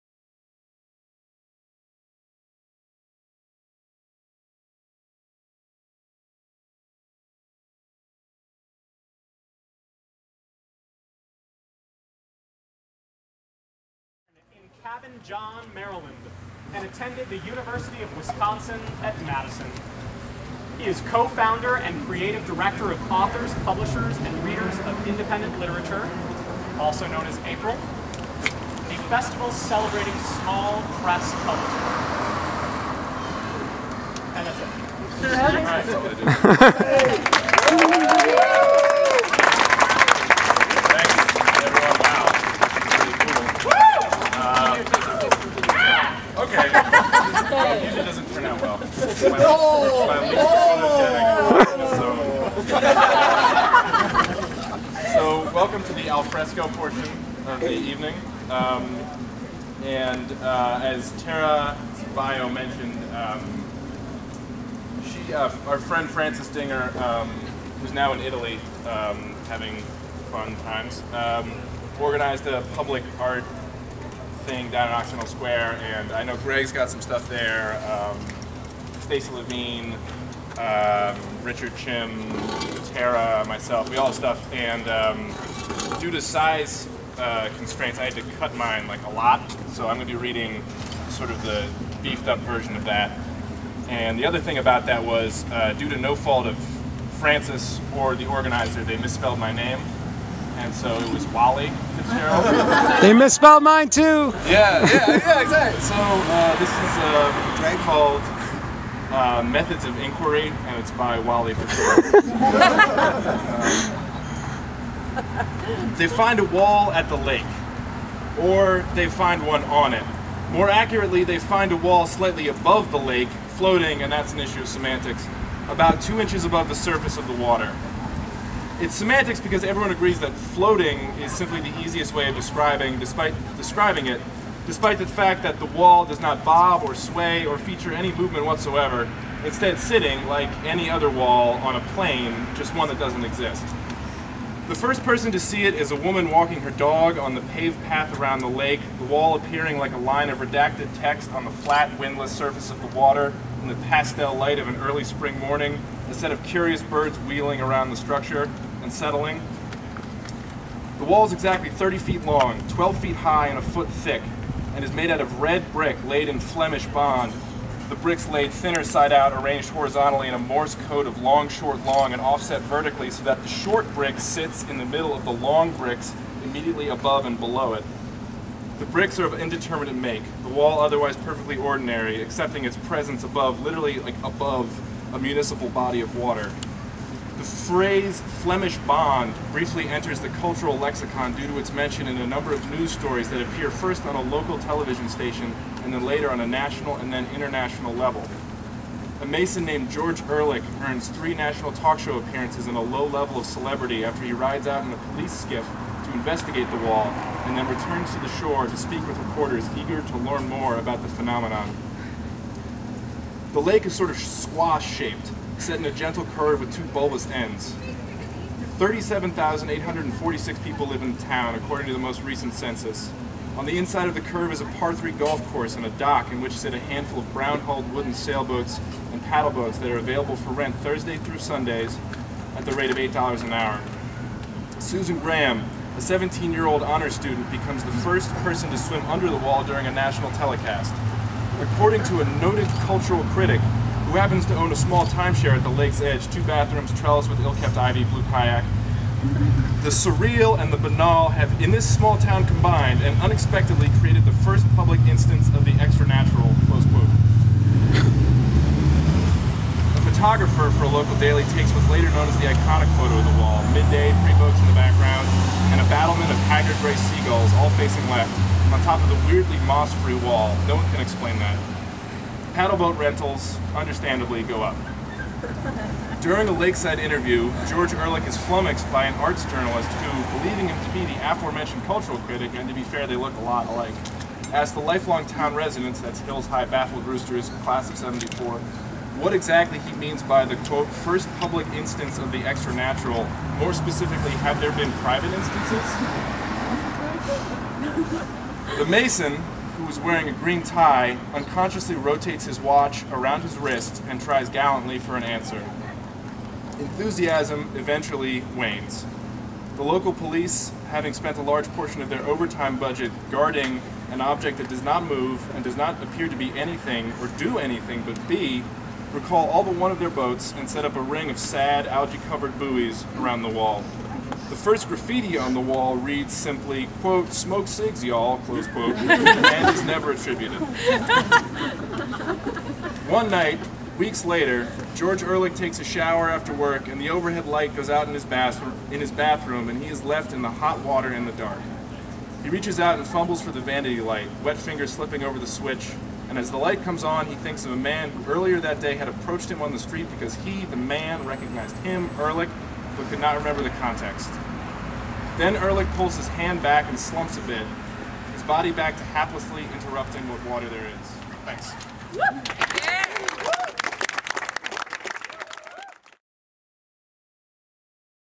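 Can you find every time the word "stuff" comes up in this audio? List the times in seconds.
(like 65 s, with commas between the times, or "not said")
77 s, 84 s.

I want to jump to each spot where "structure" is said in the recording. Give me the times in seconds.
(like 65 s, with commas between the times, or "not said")
157 s.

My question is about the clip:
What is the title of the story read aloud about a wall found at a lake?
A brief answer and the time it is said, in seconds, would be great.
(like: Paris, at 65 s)
Methods of Inquiry, at 109 s.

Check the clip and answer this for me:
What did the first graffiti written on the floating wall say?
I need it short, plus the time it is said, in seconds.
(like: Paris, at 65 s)
smoke cigs, y'all, at 327 s.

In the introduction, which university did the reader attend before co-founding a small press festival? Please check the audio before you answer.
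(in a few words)
University of Wisconsin at Madison.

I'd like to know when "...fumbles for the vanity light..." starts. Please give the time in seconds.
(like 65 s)
343 s.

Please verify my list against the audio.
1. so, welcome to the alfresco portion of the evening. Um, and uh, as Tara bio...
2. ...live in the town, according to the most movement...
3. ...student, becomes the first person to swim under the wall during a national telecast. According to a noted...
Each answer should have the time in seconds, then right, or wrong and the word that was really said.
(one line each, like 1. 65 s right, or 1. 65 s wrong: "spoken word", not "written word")
1. 55 s right
2. 220 s wrong: "recent", not "movement"
3. 237 s right.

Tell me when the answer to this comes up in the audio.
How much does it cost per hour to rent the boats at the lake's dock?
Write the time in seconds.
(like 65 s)
232 s.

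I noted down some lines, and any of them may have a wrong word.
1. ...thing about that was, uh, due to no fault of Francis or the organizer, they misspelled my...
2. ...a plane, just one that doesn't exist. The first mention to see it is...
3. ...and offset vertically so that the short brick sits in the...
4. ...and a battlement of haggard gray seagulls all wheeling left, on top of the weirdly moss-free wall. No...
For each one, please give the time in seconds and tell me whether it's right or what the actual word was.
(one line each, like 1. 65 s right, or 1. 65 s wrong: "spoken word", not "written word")
1. 94 s right
2. 141 s wrong: "person", not "mention"
3. 172 s right
4. 265 s wrong: "facing", not "wheeling".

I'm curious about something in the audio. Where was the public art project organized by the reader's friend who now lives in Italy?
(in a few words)
Occidental Square.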